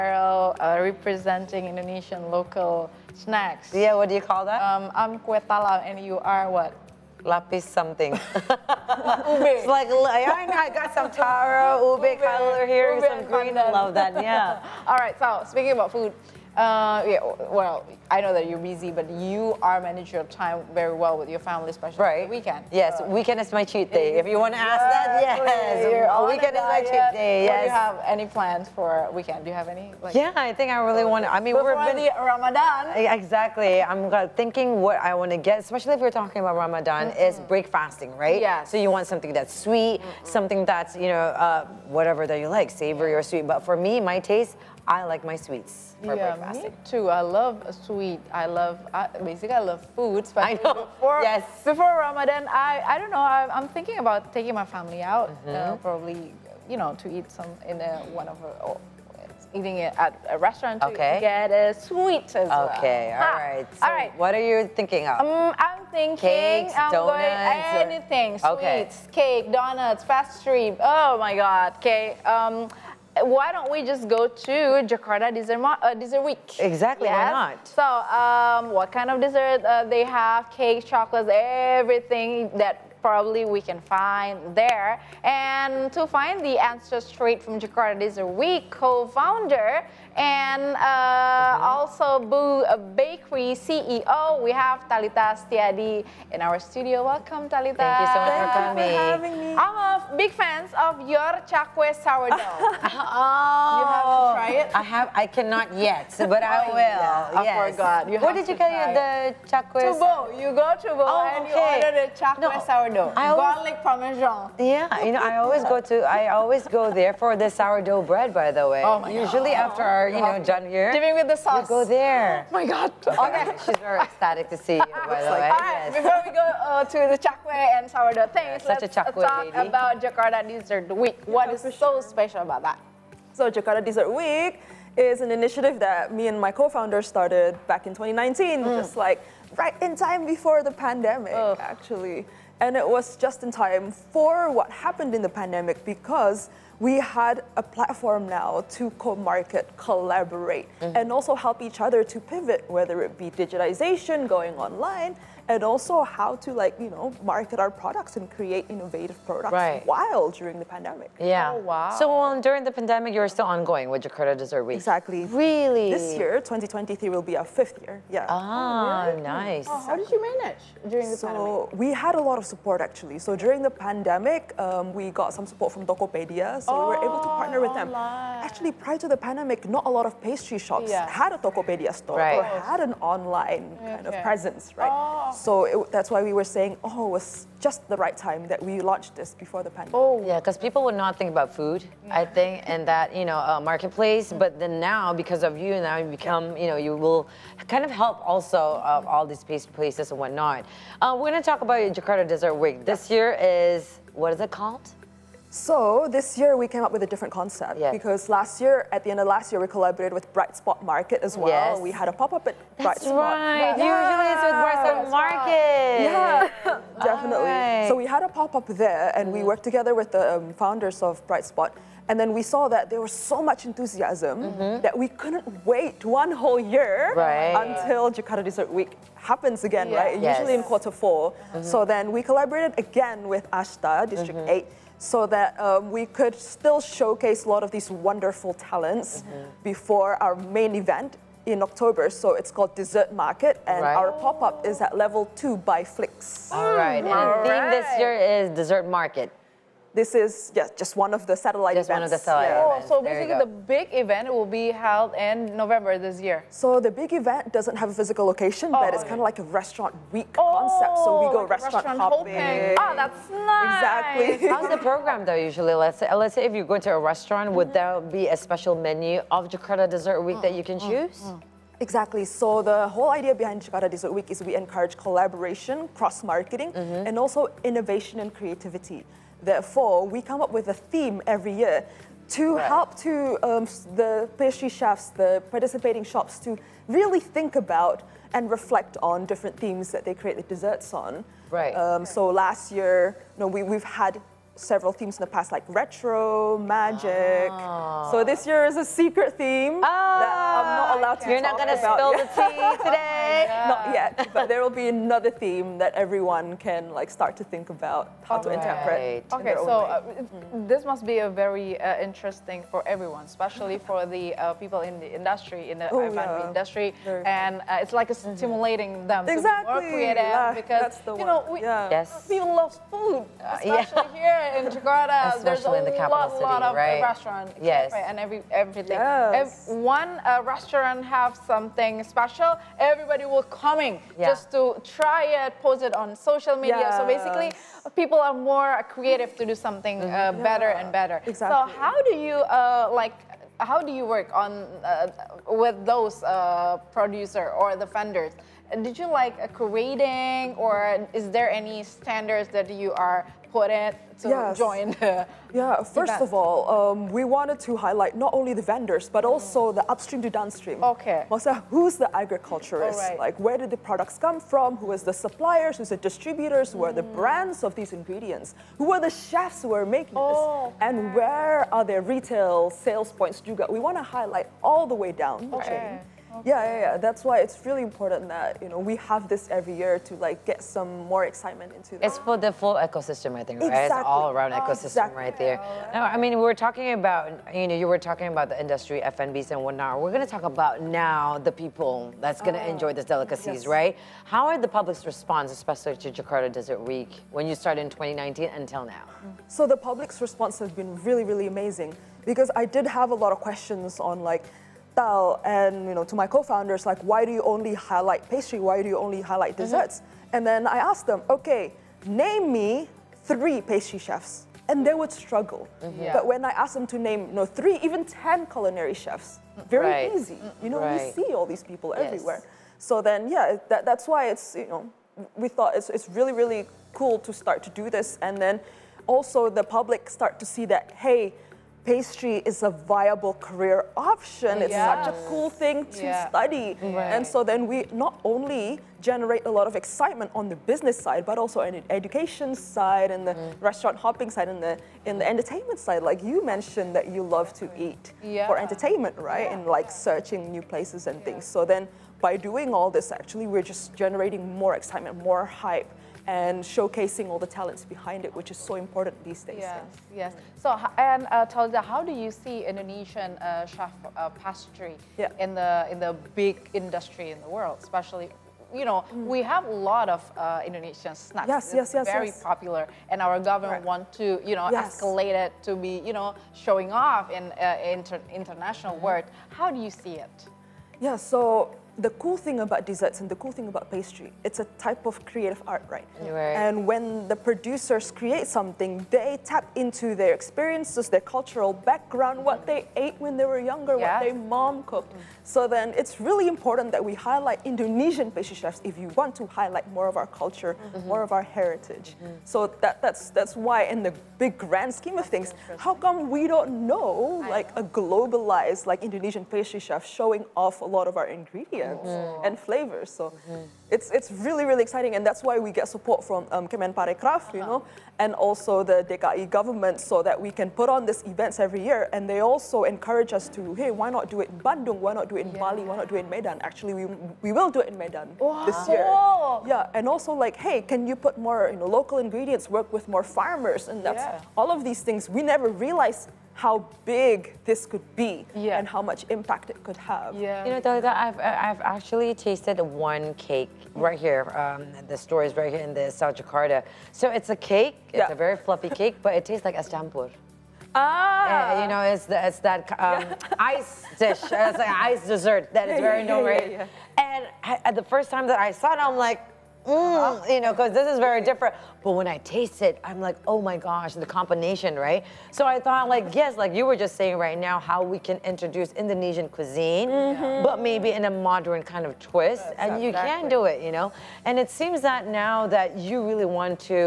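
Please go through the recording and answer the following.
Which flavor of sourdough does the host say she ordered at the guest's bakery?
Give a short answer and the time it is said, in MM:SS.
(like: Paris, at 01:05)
Garlic parmesan, at 01:53.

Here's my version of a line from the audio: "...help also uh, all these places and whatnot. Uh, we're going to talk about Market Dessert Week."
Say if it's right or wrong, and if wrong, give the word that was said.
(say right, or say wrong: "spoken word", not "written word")
wrong: "Jakarta", not "Market".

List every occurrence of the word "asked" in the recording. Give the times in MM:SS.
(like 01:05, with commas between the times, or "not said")
06:50, 06:56.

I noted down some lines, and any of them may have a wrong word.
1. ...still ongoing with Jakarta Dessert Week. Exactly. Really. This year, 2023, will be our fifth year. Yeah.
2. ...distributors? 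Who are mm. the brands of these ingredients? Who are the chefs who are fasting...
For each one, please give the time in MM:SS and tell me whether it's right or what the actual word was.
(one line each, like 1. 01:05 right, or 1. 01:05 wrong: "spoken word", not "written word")
1. 02:43 right
2. 06:05 wrong: "making", not "fasting".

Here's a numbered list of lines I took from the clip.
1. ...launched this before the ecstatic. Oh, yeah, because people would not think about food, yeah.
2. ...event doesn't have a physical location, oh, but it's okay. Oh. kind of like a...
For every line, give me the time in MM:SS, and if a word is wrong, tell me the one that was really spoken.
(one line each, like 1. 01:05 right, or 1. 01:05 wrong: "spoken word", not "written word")
1. 03:08 wrong: "pandemic", not "ecstatic"
2. 04:17 right.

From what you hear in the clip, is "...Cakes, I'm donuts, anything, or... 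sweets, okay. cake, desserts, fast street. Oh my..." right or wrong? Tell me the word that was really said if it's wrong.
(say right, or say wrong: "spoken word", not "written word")
wrong: "donuts", not "desserts".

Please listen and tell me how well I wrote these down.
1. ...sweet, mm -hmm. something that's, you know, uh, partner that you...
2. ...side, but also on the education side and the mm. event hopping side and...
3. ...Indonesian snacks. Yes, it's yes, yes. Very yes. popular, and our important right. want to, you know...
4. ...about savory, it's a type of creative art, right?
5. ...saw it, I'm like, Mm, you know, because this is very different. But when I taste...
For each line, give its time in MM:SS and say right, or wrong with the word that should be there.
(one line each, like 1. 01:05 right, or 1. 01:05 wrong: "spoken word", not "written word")
1. 00:39 wrong: "whatever", not "partner"
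2. 07:20 wrong: "restaurant", not "event"
3. 07:50 wrong: "government", not "important"
4. 08:03 wrong: "pastry", not "savory"
5. 09:18 right.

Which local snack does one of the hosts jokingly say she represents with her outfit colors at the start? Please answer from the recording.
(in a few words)
Kue talam.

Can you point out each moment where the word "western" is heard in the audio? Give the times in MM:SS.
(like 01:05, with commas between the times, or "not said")
not said.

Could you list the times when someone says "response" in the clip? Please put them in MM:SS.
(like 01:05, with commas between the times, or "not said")
06:35, 06:40.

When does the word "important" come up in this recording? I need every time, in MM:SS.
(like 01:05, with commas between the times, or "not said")
06:17, 07:38, 08:16.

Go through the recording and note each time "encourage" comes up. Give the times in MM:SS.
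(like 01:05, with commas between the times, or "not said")
04:34, 08:42.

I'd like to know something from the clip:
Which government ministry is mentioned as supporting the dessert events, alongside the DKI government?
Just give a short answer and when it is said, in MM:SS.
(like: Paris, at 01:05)
Kemenparekraf, at 08:36.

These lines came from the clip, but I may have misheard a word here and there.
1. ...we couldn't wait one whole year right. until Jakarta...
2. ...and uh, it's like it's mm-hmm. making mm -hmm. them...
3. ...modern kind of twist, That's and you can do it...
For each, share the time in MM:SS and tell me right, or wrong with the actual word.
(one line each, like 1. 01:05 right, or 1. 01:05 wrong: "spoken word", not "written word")
1. 03:44 right
2. 05:17 wrong: "stimulating", not "making"
3. 09:31 right.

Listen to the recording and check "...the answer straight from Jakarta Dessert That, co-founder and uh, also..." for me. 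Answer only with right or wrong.
wrong.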